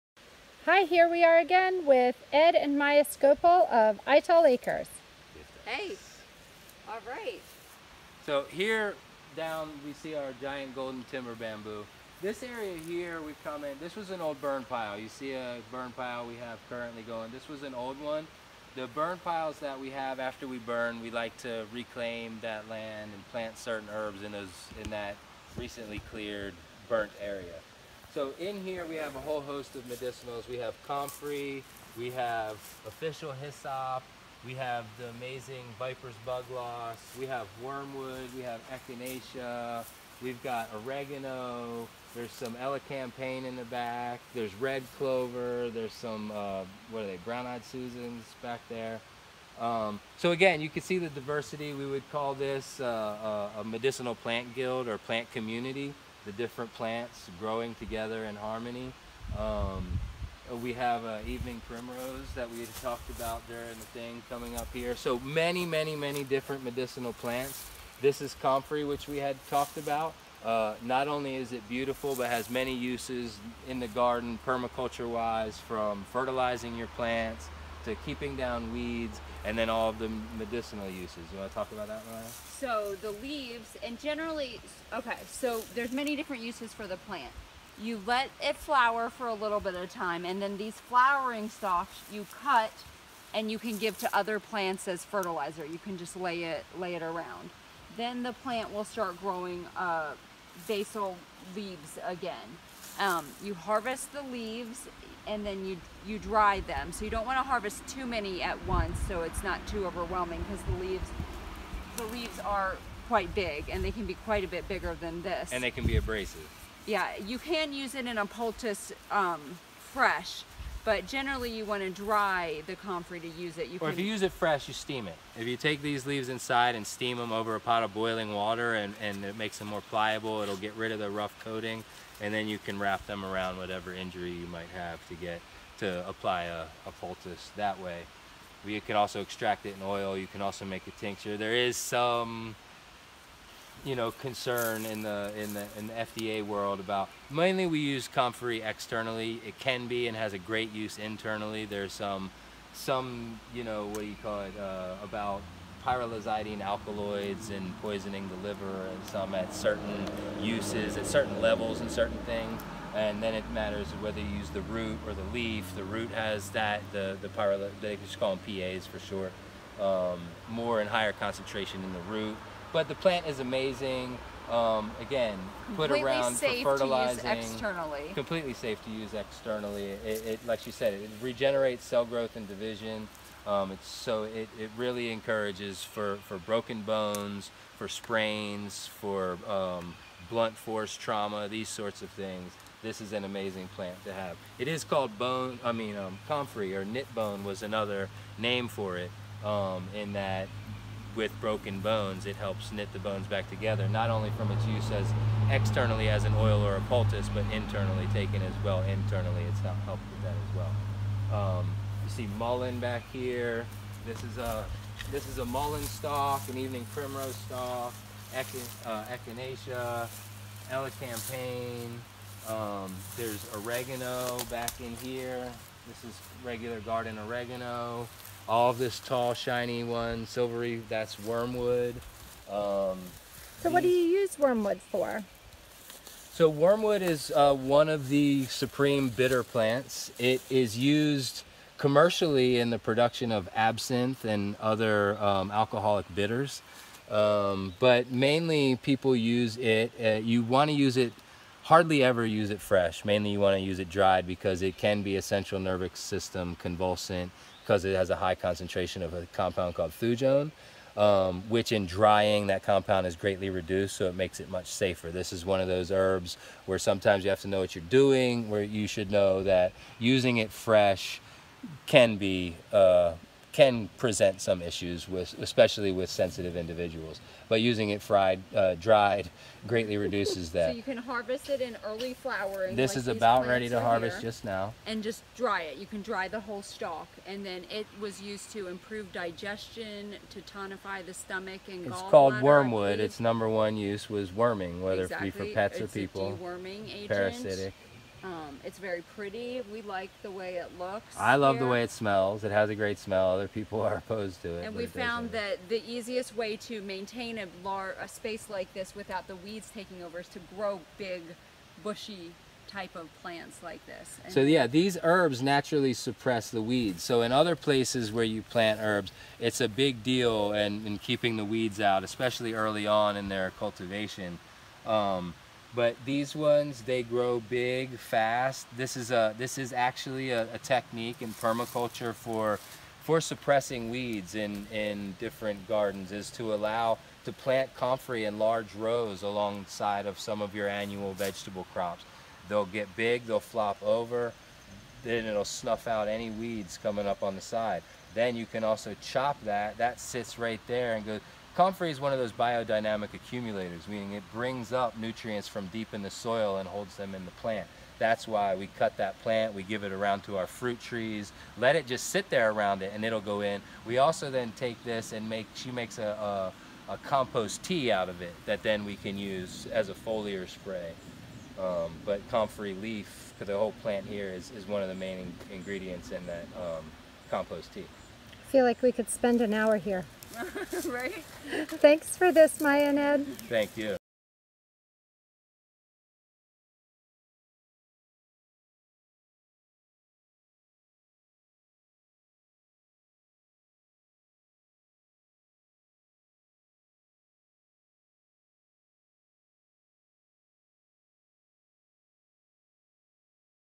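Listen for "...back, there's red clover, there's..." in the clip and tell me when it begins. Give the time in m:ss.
0:43.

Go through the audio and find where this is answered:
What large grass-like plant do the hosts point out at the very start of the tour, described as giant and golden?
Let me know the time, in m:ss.
0:10.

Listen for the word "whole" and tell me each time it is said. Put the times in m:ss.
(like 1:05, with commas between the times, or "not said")
0:29, 4:46, 6:13.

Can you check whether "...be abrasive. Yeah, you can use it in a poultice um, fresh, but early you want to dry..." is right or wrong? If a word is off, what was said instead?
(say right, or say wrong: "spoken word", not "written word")
wrong: "generally", not "early".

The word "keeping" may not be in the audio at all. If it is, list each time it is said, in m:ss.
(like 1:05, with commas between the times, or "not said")
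1:18, 5:20.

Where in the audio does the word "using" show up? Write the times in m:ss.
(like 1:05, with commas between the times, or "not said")
4:29, 4:37.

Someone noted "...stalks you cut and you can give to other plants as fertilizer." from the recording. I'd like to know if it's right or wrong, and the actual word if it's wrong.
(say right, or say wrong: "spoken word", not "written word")
right.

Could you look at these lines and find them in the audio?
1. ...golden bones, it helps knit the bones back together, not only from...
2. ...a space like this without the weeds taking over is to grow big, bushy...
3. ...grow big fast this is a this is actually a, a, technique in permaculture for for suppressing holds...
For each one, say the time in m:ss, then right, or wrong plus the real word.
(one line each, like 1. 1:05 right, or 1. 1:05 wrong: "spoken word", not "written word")
1. 3:21 wrong: "broken", not "golden"
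2. 5:07 right
3. 5:27 wrong: "weeds", not "holds".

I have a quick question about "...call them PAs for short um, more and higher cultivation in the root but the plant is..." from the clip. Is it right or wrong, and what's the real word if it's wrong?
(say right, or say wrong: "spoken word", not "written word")
wrong: "concentration", not "cultivation".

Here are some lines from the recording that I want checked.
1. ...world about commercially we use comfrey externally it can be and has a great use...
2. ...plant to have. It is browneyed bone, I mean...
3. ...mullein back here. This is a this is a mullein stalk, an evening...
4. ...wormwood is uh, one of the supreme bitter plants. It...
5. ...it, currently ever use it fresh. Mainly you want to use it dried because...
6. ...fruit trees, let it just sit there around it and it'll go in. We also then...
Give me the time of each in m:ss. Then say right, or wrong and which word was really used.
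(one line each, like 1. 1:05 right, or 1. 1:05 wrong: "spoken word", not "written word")
1. 2:26 wrong: "mainly", not "commercially"
2. 3:13 wrong: "called", not "browneyed"
3. 3:32 right
4. 3:56 right
5. 4:10 wrong: "hardly", not "currently"
6. 6:00 right.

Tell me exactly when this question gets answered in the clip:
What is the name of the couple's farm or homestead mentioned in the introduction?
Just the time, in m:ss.
0:04.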